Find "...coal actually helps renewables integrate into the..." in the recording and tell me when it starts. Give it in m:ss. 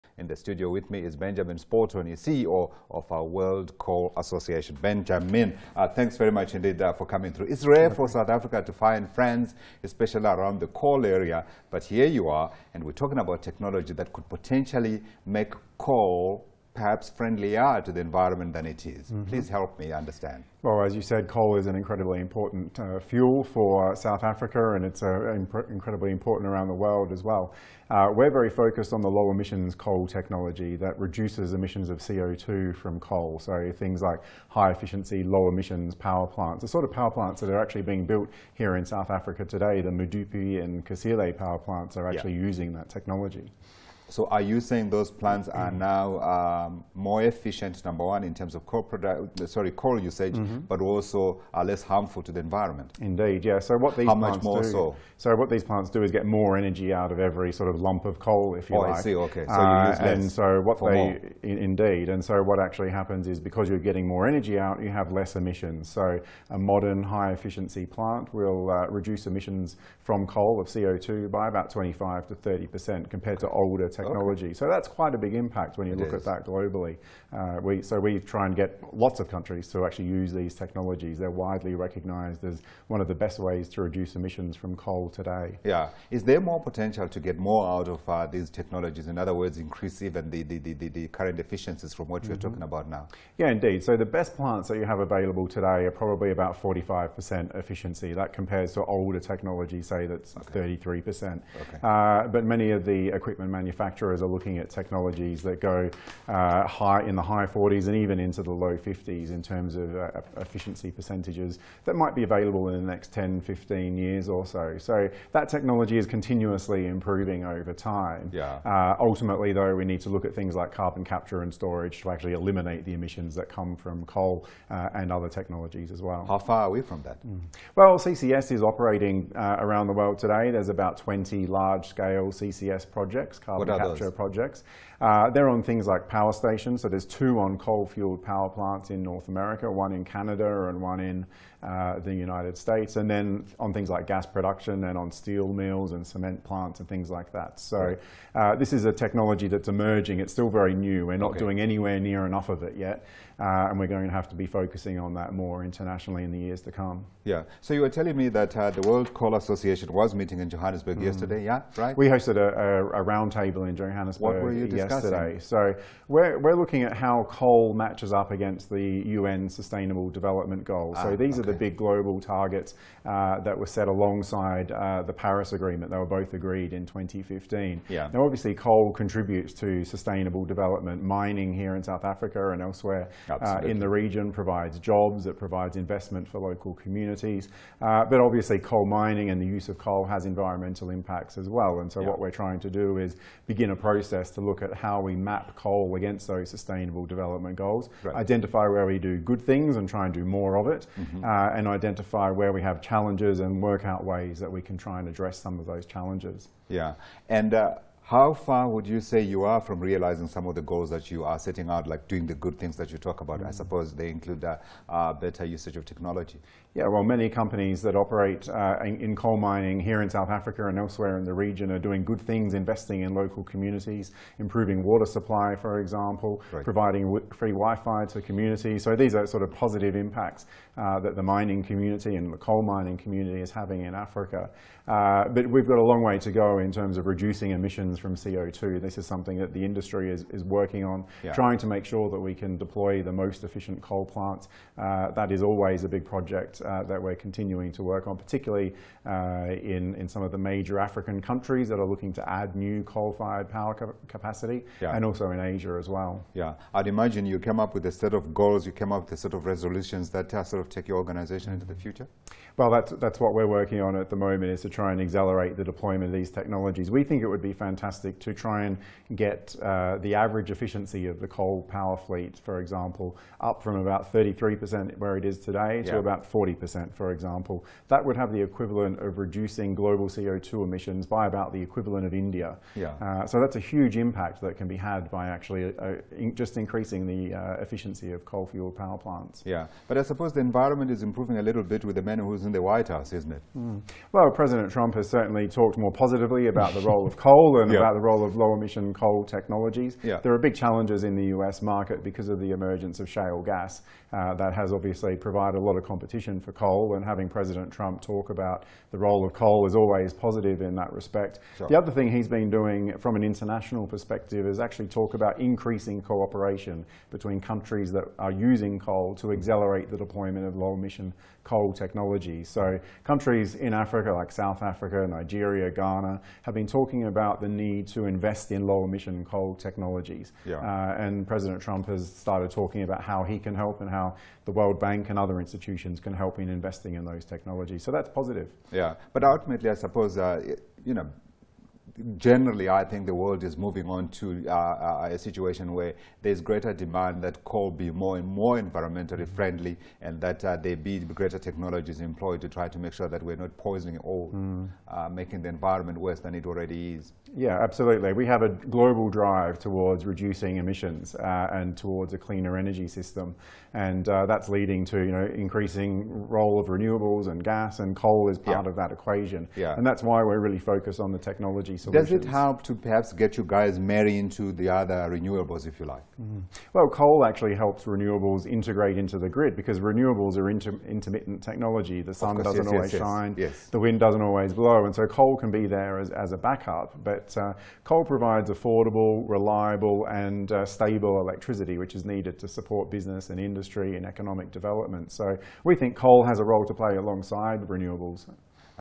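6:16.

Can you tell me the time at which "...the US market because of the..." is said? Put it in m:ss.
5:01.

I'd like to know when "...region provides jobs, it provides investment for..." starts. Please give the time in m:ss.
3:03.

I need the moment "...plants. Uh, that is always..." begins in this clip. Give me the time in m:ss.
4:04.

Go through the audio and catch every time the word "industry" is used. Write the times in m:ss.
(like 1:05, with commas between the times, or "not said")
3:59, 6:33.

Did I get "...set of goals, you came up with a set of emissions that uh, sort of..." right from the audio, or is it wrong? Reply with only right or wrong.
wrong.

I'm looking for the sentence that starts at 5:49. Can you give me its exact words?
friendly and that uh, there be greater technologies employed to try to make sure that we're not poisoning or mm.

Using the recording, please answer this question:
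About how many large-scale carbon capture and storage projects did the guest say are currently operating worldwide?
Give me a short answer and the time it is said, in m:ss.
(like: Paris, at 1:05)
20, at 2:10.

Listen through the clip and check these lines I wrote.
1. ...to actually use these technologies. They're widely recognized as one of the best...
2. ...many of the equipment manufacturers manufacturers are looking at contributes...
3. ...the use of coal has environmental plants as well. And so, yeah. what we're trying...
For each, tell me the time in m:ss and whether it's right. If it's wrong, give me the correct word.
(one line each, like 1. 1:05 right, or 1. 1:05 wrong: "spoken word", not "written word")
1. 1:19 right
2. 1:42 wrong: "technologies", not "contributes"
3. 3:09 wrong: "impacts", not "plants".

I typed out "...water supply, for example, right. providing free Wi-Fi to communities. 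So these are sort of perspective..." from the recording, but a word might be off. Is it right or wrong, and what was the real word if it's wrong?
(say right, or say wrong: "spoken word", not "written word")
wrong: "positive", not "perspective".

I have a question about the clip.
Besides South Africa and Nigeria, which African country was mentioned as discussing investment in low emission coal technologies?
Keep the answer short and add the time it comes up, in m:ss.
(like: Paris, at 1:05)
Ghana, at 5:25.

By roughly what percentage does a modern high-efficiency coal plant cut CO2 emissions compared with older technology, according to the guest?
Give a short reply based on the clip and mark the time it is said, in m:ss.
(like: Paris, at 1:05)
25 to 30%, at 1:11.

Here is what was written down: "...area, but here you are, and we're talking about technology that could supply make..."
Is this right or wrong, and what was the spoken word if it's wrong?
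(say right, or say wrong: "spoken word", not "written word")
wrong: "potentially", not "supply".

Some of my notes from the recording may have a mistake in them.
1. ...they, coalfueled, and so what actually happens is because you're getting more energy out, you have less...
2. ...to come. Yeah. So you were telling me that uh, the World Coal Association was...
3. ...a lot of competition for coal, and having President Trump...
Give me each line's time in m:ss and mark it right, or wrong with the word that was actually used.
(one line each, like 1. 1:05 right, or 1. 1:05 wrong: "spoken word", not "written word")
1. 1:00 wrong: "indeed", not "coalfueled"
2. 2:36 right
3. 5:05 right.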